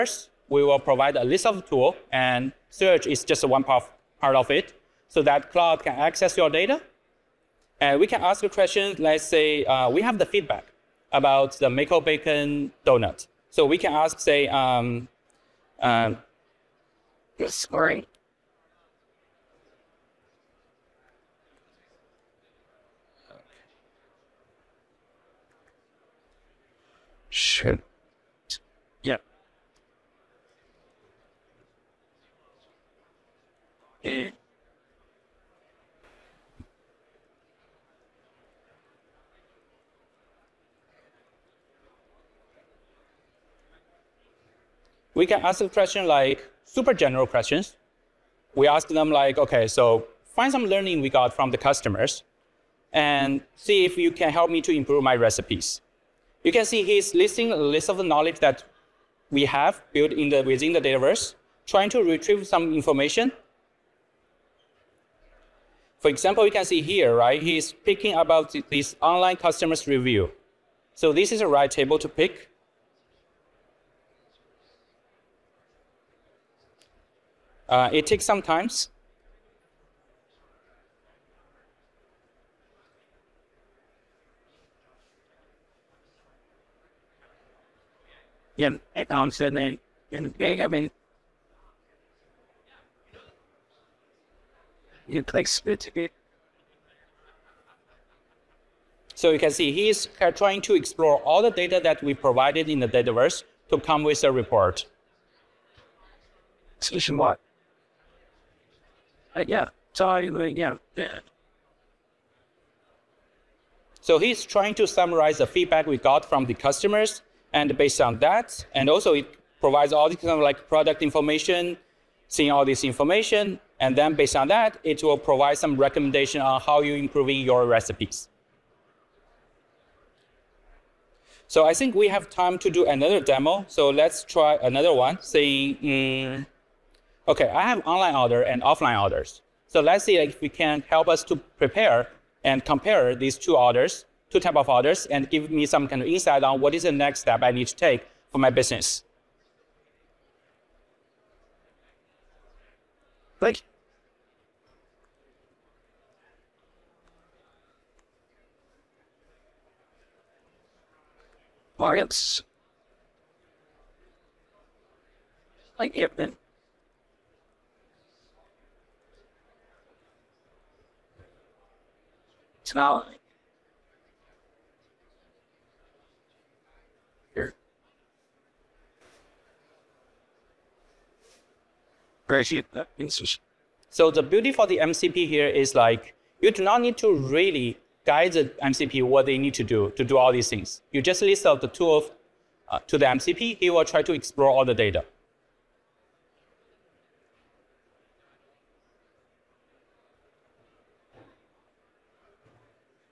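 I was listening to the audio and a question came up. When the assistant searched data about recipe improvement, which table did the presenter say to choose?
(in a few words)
online customer's review.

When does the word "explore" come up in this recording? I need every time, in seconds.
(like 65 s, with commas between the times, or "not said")
100 s, 194 s.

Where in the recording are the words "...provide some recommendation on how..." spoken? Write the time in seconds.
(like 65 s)
125 s.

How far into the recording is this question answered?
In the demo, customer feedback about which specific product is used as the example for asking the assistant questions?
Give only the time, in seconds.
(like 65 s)
11 s.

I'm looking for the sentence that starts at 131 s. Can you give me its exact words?
So I think we have time to do another demo.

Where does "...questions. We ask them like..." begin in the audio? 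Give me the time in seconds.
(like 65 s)
47 s.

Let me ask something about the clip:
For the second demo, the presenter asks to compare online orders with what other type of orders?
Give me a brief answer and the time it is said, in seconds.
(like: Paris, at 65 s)
offline orders, at 138 s.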